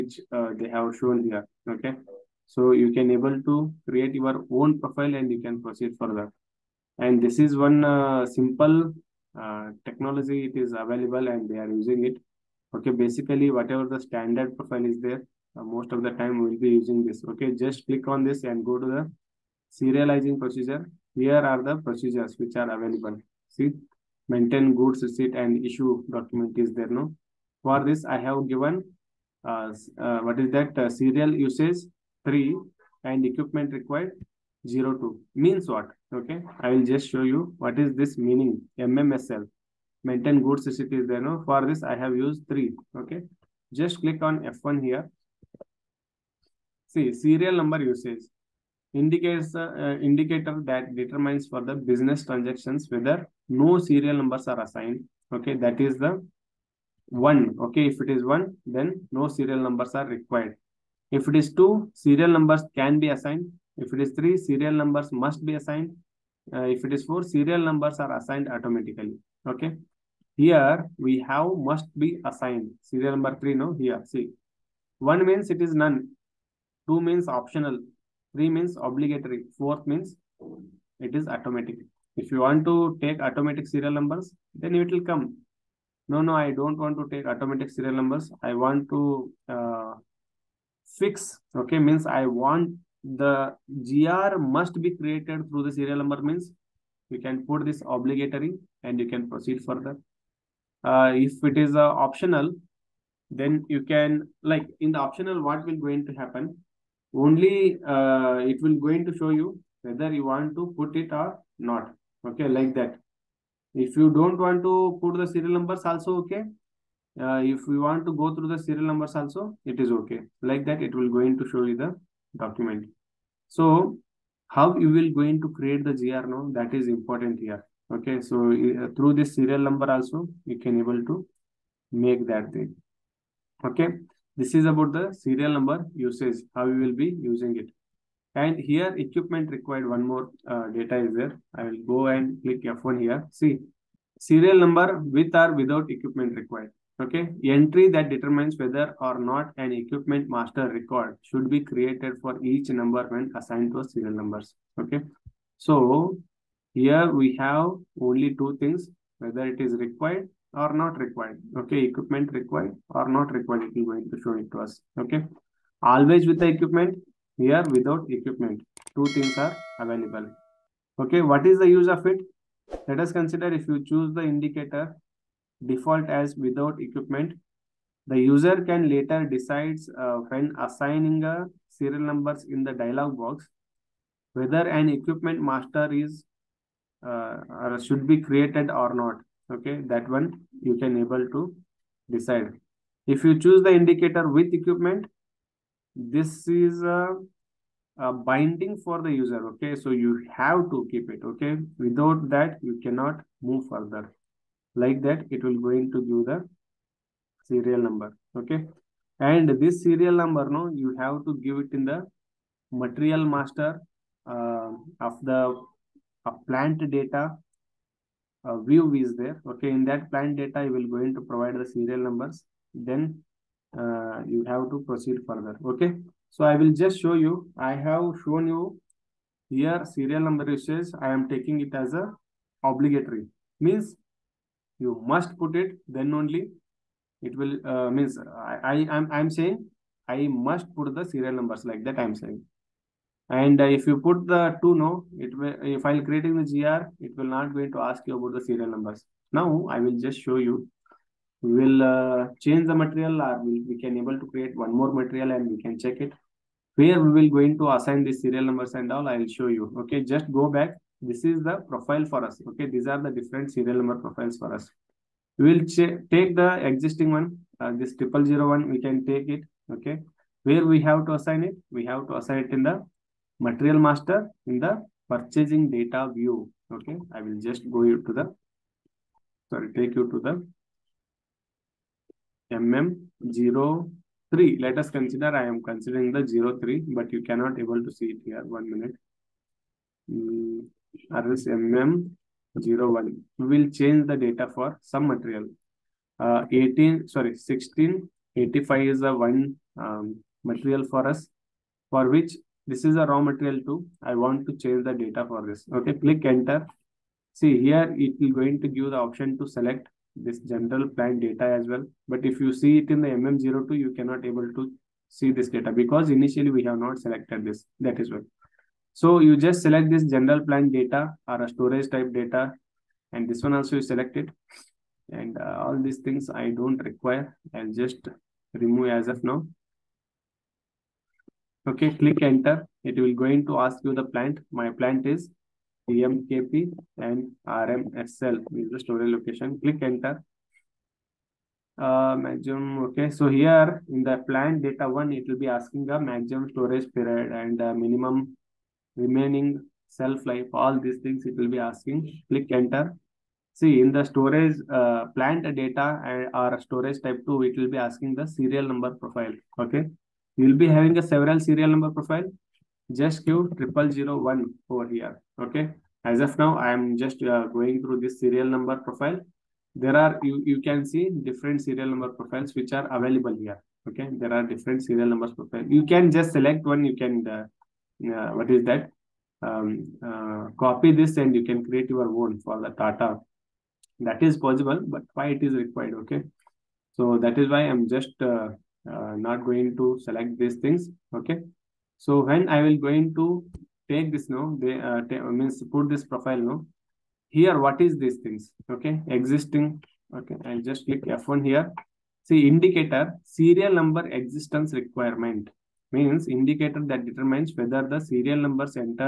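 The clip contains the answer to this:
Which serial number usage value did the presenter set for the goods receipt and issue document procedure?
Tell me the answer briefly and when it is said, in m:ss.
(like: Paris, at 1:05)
3, at 0:30.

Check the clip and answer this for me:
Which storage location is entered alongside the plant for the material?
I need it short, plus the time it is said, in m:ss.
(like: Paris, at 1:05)
RMSL, at 5:37.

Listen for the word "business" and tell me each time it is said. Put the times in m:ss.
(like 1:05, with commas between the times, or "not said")
0:51.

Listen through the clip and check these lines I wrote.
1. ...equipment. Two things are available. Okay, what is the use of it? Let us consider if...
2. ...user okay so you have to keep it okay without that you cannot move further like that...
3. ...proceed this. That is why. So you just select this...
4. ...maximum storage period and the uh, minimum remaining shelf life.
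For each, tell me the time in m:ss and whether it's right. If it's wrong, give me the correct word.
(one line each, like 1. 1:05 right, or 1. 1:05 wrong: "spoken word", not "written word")
1. 2:48 right
2. 3:19 right
3. 5:16 wrong: "selected", not "proceed"
4. 5:45 right.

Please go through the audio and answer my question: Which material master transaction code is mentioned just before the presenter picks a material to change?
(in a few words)
MM01.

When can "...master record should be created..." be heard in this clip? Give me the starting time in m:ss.
2:30.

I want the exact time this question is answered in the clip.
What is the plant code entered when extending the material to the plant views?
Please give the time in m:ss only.
5:35.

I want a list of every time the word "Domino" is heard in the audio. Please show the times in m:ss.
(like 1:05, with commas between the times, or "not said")
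not said.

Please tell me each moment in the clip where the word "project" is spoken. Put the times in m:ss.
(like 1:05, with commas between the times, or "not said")
not said.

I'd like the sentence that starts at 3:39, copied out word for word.
Okay, in that plant data, you will going to provide the serial numbers.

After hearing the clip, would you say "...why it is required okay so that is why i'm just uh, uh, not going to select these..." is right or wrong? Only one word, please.
right.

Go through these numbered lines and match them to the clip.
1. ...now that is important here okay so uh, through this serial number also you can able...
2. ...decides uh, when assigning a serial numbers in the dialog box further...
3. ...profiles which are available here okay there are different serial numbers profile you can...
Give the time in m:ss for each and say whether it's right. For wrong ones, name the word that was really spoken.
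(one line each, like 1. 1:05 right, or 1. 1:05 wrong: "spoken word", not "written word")
1. 2:06 right
2. 2:59 wrong: "whether", not "further"
3. 6:12 right.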